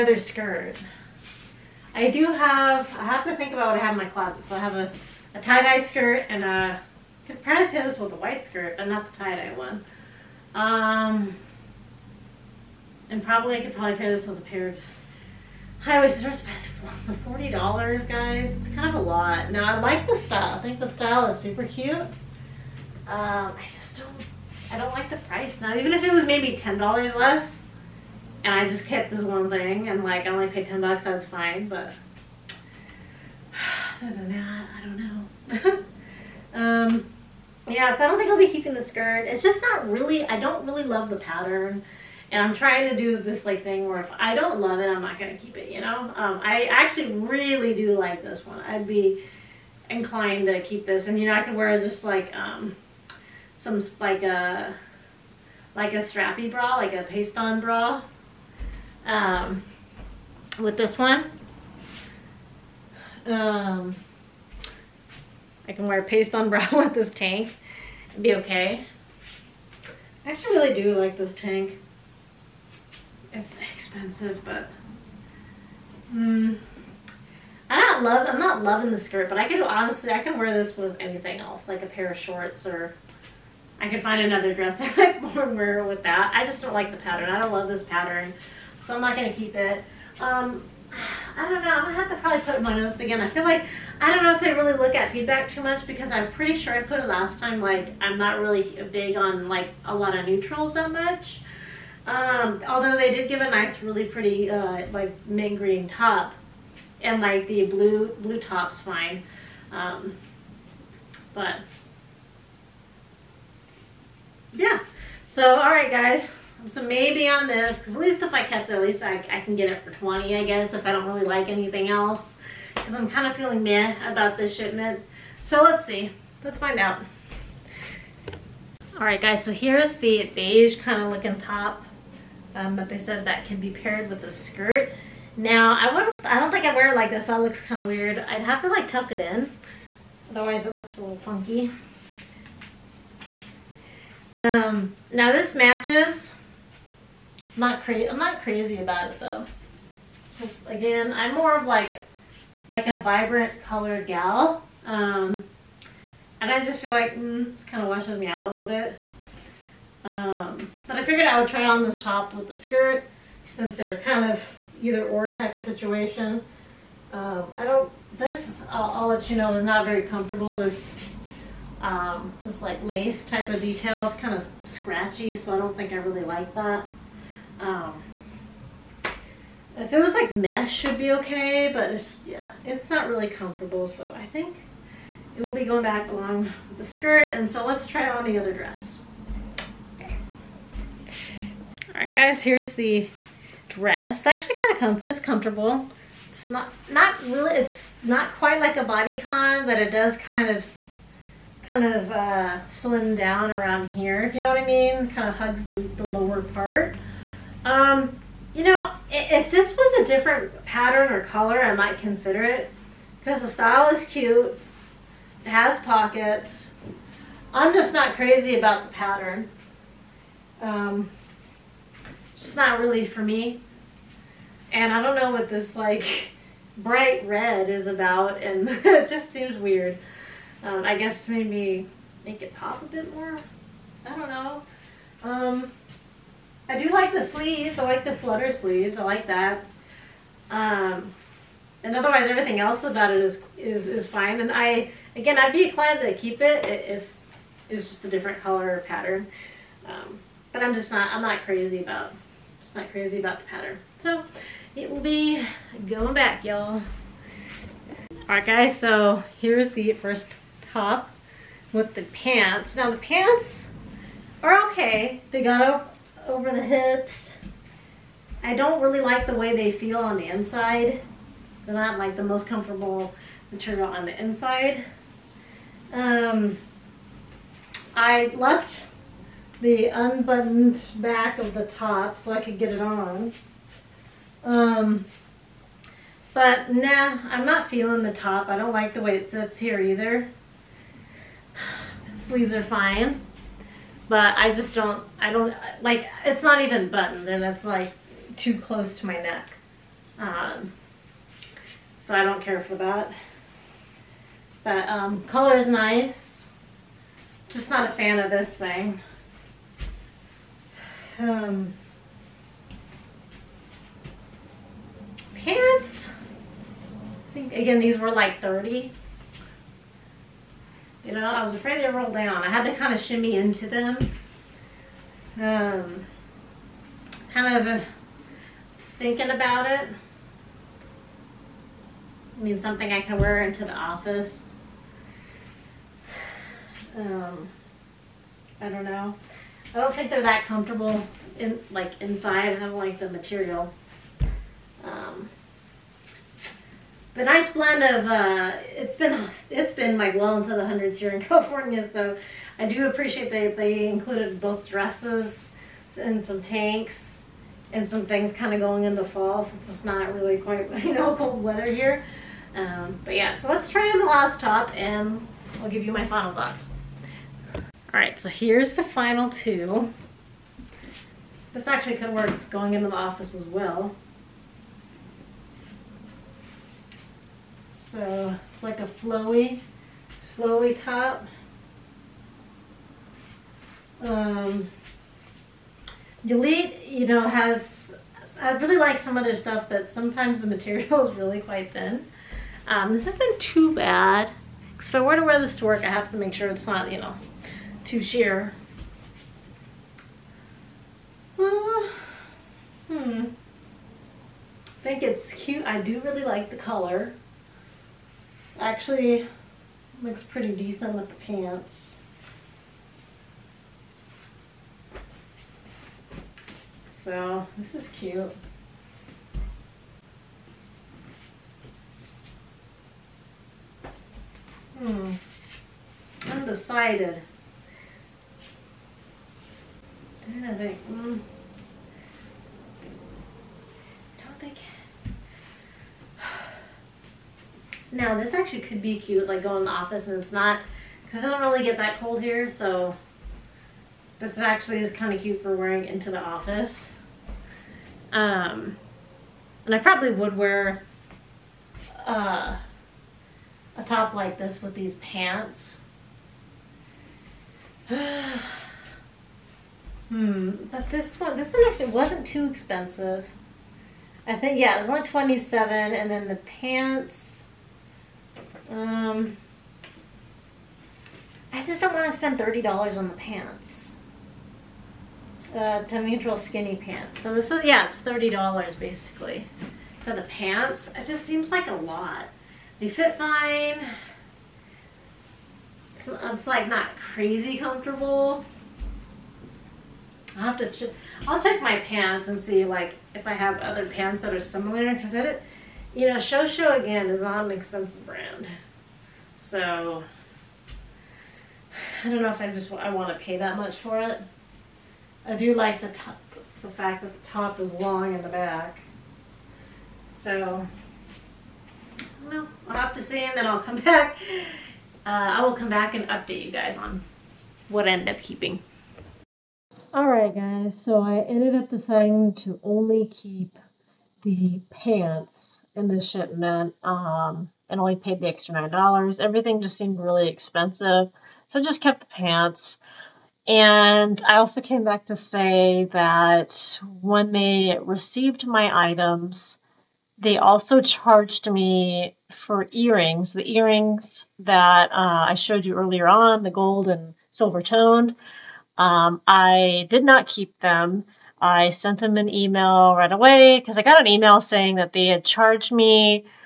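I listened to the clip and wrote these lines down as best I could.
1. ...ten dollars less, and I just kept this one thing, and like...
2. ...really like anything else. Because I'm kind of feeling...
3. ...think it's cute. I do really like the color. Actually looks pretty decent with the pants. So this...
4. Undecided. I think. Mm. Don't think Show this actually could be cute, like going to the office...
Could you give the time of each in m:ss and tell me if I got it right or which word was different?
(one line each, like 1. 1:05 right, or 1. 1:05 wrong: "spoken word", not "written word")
1. 0:26 right
2. 2:01 right
3. 6:44 right
4. 7:06 wrong: "Now", not "Show".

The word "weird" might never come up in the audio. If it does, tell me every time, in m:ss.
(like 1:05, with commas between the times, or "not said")
2:17, 3:49.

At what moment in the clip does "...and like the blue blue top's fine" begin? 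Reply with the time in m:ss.
1:47.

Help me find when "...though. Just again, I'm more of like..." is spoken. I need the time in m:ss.
2:29.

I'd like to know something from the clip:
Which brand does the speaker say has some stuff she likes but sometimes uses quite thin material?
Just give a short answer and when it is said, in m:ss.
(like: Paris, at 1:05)
Delete, at 6:26.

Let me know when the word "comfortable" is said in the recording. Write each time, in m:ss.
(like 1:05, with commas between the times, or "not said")
2:50, 3:03, 3:15, 4:32, 5:40, 8:07.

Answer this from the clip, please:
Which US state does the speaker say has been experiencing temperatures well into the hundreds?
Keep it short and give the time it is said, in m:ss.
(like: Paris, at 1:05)
California, at 5:51.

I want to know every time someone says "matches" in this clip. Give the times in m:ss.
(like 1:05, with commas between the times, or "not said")
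2:25.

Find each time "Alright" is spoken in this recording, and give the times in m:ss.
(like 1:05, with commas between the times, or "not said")
2:08, 4:18, 8:39.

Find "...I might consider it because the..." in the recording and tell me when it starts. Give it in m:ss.
3:31.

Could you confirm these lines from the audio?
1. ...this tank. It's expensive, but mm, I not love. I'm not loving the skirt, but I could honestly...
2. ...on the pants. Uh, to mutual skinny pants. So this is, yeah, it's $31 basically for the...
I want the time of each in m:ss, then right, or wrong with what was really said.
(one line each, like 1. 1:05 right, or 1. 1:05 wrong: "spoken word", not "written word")
1. 1:11 right
2. 7:52 wrong: "30", not "31".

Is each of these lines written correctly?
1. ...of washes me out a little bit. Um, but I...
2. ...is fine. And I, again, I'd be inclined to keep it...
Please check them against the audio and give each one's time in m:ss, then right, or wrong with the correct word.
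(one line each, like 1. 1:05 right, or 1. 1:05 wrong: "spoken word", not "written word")
1. 2:37 right
2. 4:03 right.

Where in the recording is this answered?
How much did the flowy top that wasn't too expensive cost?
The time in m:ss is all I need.
7:45.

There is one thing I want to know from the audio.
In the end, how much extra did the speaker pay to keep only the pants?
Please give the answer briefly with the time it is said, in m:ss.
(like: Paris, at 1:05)
$9, at 8:48.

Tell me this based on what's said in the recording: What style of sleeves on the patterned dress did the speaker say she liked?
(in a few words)
flutter sleeves.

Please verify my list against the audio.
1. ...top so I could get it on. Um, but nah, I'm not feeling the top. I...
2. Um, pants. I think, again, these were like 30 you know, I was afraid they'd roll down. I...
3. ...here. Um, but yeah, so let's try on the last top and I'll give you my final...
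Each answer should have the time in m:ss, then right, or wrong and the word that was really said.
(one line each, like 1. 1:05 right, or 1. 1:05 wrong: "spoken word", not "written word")
1. 4:41 right
2. 5:11 right
3. 6:01 right.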